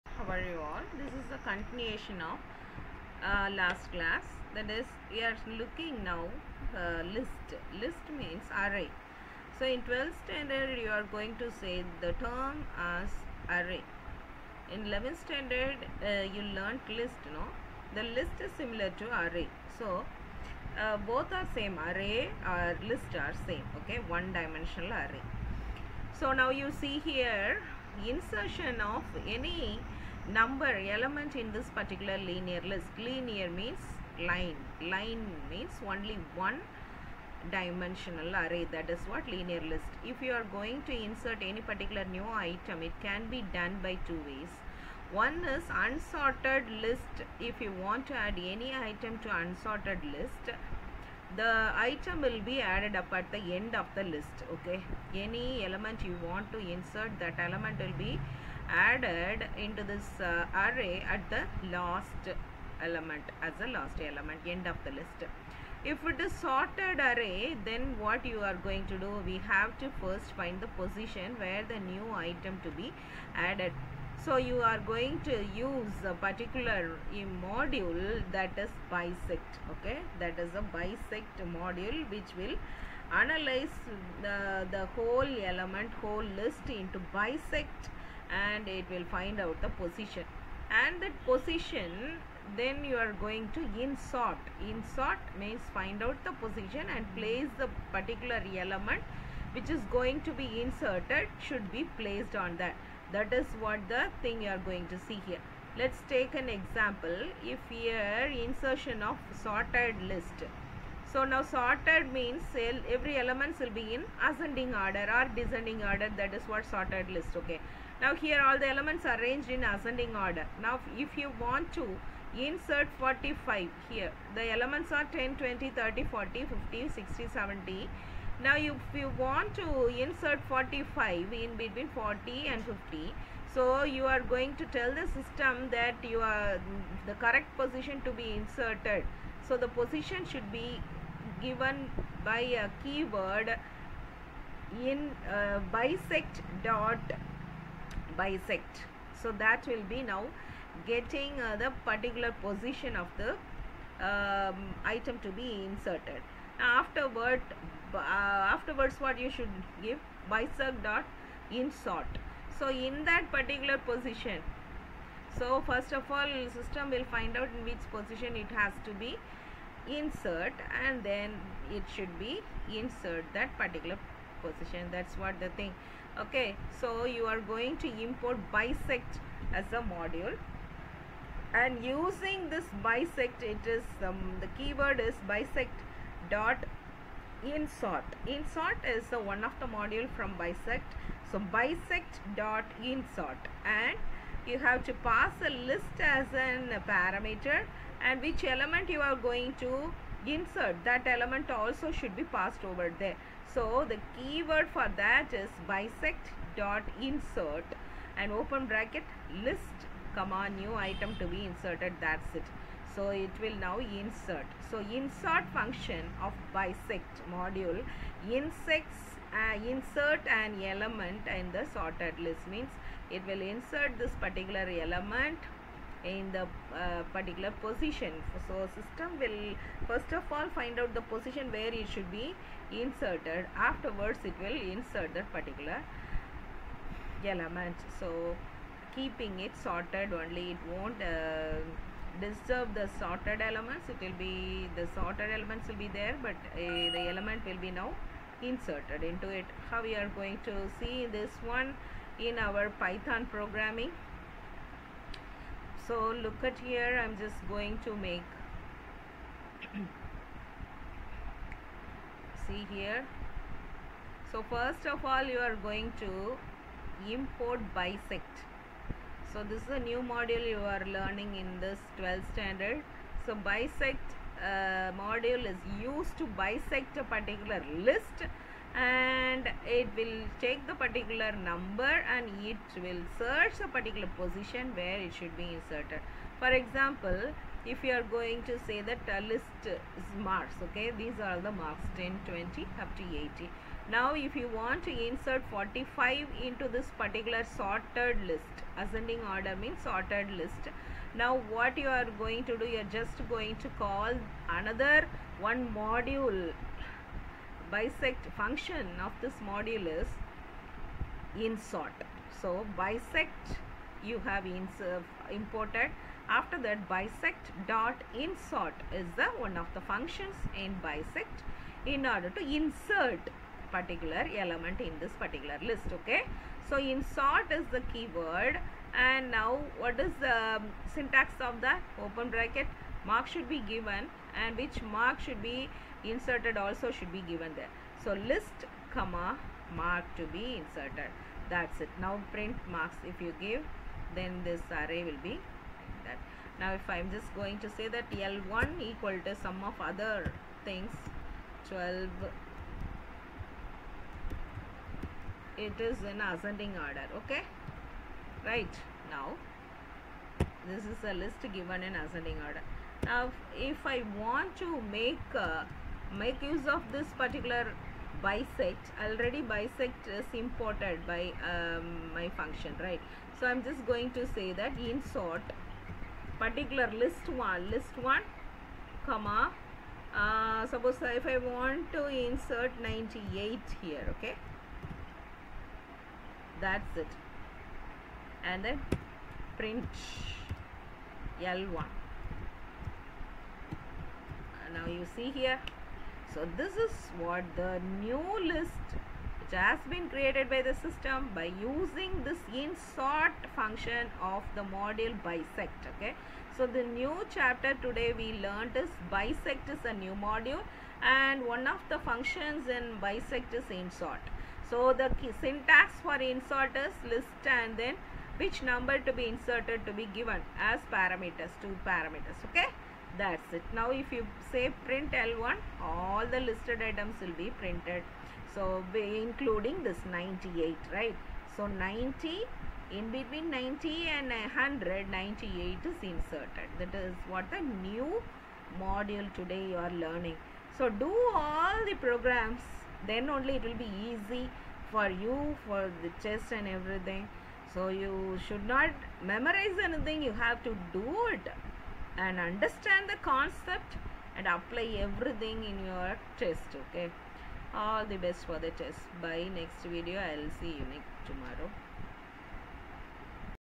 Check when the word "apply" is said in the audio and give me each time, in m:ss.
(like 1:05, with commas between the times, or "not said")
7:34.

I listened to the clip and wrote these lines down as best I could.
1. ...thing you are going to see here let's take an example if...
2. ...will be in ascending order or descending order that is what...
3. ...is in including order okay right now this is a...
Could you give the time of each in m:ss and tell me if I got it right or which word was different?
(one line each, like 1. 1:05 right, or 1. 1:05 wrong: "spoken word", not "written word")
1. 1:44 right
2. 1:53 right
3. 5:55 wrong: "ascending", not "including".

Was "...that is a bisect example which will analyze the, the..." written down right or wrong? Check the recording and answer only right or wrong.
wrong.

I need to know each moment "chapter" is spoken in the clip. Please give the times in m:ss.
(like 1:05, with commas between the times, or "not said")
6:47.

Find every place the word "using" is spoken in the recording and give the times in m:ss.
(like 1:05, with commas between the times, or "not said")
3:01, 6:41.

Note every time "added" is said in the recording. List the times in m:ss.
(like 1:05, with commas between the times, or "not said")
0:52, 0:58, 1:13.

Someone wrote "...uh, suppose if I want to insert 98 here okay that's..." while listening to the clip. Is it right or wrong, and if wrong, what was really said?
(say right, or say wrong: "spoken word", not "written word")
right.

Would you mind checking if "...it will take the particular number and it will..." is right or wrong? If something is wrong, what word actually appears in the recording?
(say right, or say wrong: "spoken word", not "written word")
right.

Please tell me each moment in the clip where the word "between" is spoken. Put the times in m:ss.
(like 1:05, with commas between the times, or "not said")
2:11, 7:13.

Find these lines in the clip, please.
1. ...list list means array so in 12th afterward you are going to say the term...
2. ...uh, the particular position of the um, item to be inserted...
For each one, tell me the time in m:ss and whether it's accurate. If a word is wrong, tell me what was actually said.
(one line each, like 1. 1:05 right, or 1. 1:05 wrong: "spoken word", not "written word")
1. 0:07 wrong: "standard", not "afterward"
2. 2:31 right.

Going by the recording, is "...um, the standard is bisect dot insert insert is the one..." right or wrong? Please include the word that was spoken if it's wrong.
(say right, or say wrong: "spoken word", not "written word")
wrong: "keyword", not "standard".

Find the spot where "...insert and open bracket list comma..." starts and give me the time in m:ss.
3:27.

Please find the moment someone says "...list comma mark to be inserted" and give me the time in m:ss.
5:38.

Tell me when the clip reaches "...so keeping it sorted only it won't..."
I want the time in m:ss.
3:57.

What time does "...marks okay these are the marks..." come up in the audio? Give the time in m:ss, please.
4:50.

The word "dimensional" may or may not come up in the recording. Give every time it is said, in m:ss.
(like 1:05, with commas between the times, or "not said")
0:24, 0:37.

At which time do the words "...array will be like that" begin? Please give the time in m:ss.
5:44.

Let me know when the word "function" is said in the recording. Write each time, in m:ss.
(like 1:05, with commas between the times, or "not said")
3:35, 5:08, 5:19, 6:12, 6:43, 6:52.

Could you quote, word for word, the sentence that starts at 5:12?
So bisect you have uh, imported.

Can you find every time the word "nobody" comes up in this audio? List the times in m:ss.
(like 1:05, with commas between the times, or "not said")
not said.